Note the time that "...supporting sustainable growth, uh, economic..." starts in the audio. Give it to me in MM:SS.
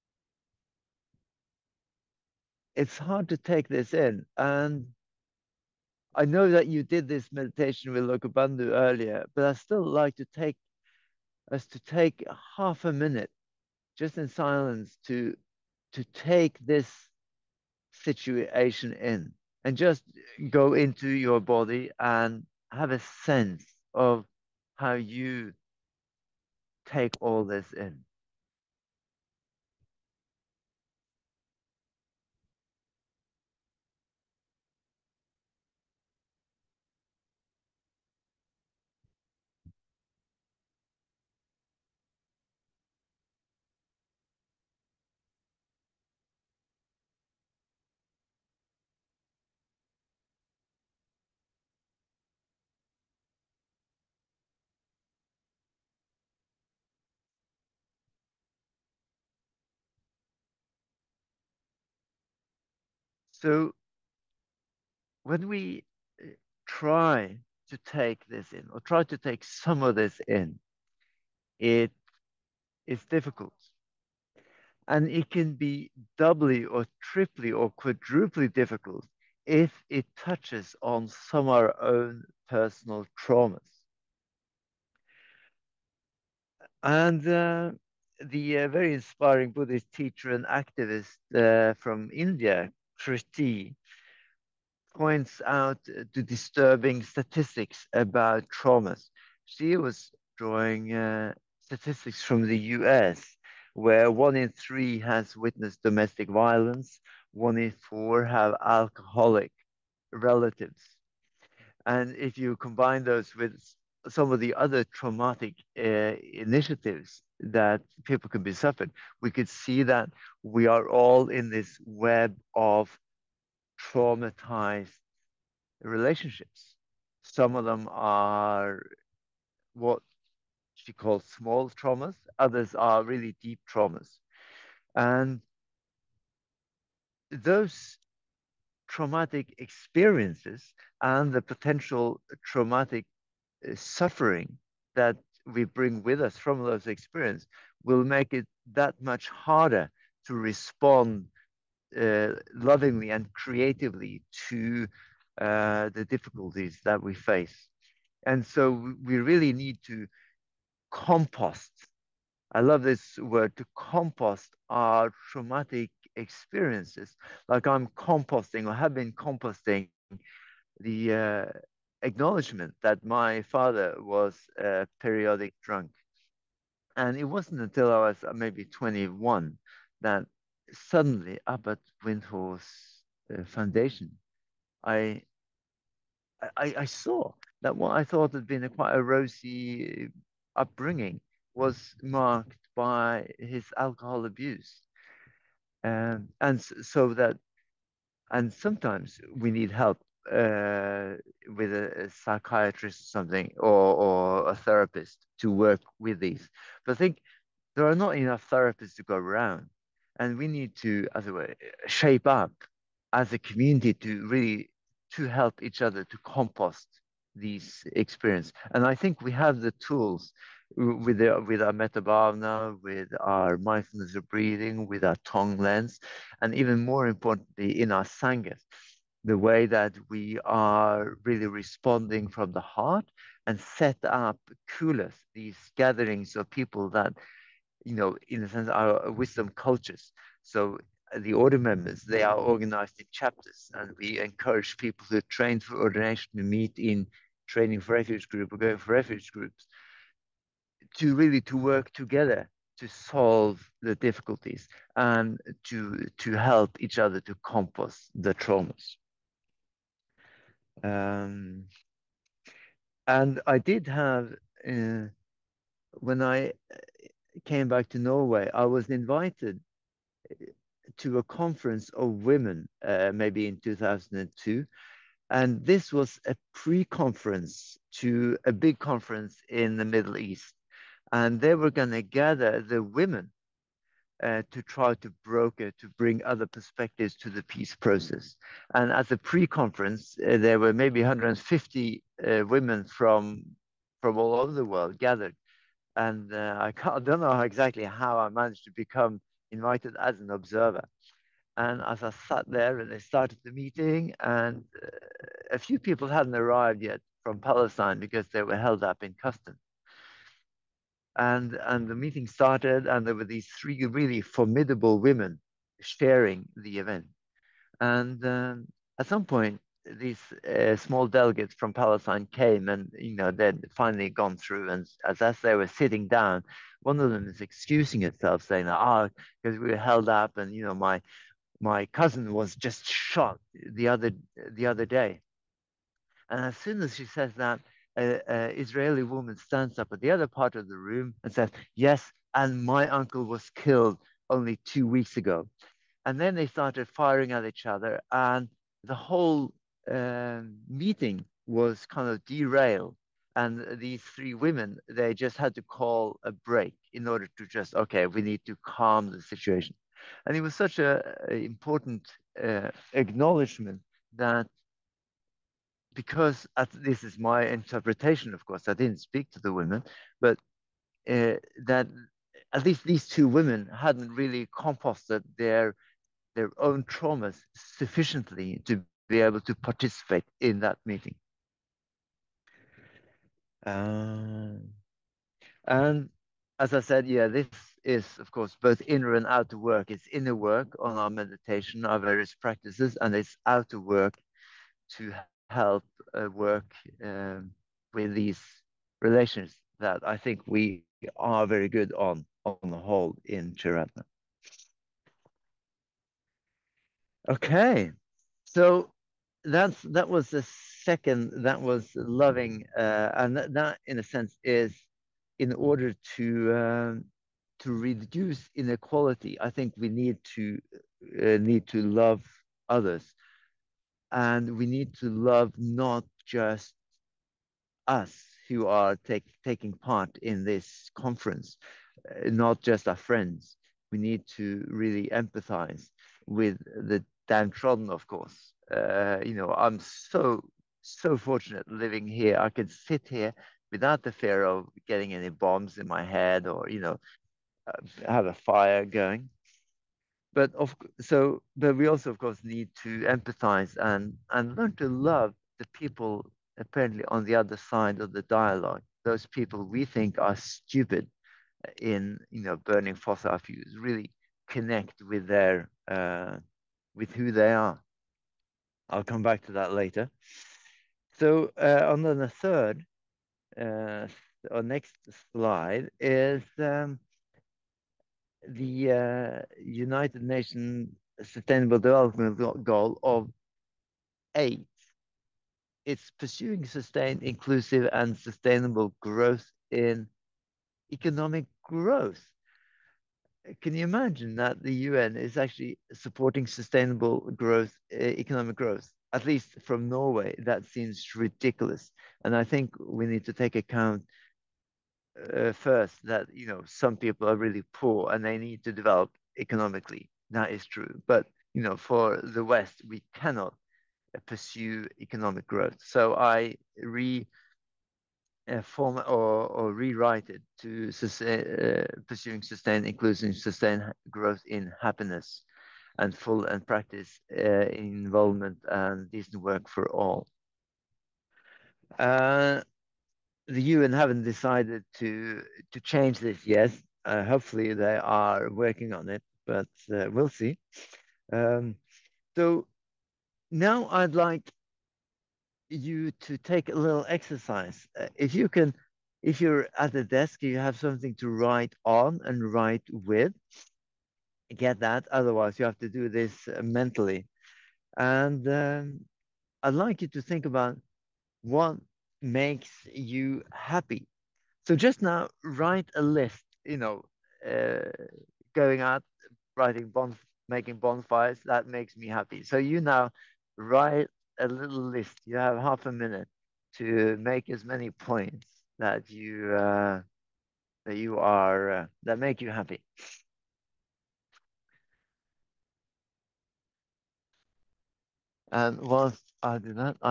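08:15.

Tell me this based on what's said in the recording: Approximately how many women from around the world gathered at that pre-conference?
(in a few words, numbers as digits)
150.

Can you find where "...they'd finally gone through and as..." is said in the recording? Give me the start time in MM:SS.
05:23.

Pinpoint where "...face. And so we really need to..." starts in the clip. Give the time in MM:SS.
02:37.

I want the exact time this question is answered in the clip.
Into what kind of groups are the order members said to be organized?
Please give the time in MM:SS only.
04:03.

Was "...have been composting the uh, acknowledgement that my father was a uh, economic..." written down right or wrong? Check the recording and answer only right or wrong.
wrong.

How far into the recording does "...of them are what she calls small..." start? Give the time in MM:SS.
02:07.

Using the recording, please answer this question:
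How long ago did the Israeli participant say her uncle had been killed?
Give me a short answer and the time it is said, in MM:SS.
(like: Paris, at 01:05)
2 weeks, at 05:44.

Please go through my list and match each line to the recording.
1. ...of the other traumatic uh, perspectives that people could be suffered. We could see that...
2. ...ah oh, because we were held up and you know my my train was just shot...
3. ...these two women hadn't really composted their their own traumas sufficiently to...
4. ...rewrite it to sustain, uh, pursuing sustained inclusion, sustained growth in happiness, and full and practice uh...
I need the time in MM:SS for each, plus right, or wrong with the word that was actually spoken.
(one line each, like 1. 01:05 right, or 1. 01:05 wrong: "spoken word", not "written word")
1. 01:54 wrong: "initiatives", not "perspectives"
2. 05:28 wrong: "cousin", not "train"
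3. 06:12 right
4. 08:39 right.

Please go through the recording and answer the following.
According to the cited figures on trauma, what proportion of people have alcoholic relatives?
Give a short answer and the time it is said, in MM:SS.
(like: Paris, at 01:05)
1 in 4, at 01:47.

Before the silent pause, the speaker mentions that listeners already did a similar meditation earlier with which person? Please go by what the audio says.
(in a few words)
Lokabandhu.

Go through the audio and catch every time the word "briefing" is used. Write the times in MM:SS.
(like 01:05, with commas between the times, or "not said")
not said.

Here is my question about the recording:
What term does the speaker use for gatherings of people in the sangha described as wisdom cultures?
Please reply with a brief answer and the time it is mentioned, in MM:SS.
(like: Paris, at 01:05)
kulas, at 03:54.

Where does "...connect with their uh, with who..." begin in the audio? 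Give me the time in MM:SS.
07:44.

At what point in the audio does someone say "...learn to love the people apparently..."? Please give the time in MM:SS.
07:34.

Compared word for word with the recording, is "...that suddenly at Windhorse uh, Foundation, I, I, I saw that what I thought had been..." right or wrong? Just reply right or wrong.
right.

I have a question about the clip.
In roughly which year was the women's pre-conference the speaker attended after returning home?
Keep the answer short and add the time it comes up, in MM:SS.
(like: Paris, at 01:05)
2002, at 04:33.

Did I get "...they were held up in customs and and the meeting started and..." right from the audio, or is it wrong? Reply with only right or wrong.
right.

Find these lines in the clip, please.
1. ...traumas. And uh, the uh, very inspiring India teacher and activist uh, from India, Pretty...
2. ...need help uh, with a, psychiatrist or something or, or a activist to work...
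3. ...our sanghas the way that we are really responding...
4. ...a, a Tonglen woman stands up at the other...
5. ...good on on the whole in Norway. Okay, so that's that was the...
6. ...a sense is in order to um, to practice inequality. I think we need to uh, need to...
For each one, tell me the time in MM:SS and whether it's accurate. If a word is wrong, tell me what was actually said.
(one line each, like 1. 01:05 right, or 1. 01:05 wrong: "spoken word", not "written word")
1. 01:23 wrong: "Buddhist", not "India"
2. 03:19 wrong: "therapist", not "activist"
3. 03:47 right
4. 05:37 wrong: "Israeli", not "Tonglen"
5. 06:41 wrong: "Triratna", not "Norway"
6. 06:53 wrong: "reduce", not "practice".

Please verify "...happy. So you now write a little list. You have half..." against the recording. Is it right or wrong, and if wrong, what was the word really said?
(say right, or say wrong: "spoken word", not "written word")
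right.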